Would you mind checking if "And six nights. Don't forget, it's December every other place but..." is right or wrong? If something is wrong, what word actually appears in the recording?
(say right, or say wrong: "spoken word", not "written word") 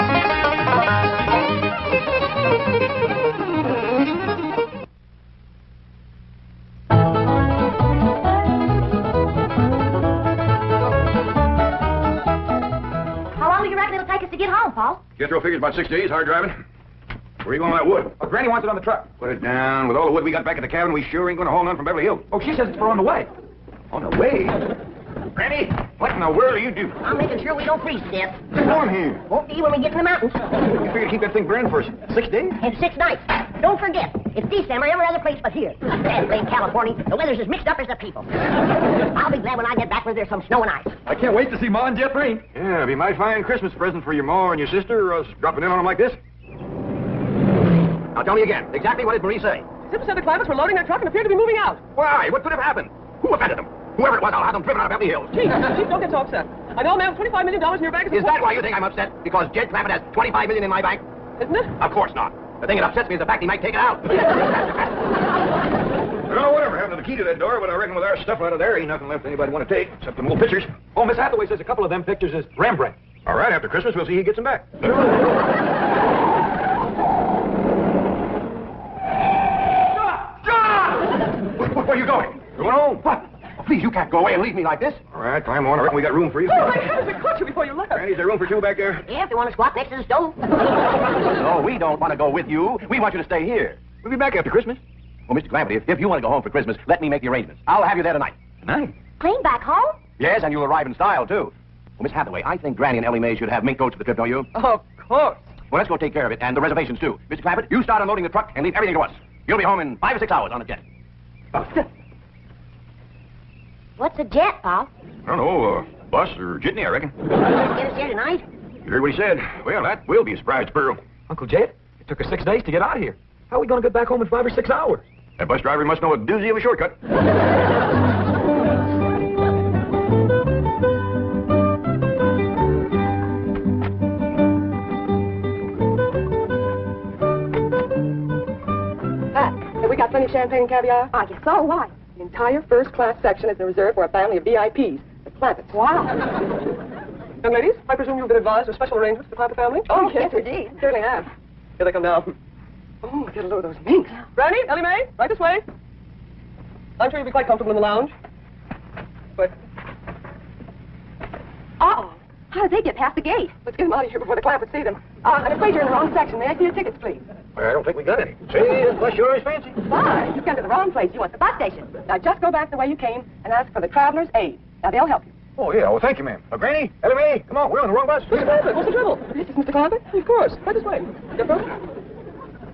right.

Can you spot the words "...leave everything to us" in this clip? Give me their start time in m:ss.
1:48.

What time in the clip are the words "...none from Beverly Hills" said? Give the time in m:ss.
0:21.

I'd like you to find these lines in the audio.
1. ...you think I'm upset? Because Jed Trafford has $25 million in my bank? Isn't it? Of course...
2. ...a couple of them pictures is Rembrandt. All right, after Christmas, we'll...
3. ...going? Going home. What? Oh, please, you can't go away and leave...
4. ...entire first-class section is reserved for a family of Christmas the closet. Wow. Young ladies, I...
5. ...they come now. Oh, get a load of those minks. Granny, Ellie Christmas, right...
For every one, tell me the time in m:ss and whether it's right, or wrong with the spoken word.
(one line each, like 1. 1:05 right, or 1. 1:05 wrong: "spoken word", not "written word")
1. 0:58 right
2. 1:11 right
3. 1:22 right
4. 2:22 wrong: "VIPs", not "Christmas"
5. 2:31 wrong: "Mae", not "Christmas".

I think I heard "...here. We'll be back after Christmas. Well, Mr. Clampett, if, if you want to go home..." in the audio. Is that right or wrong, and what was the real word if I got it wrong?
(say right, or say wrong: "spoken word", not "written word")
right.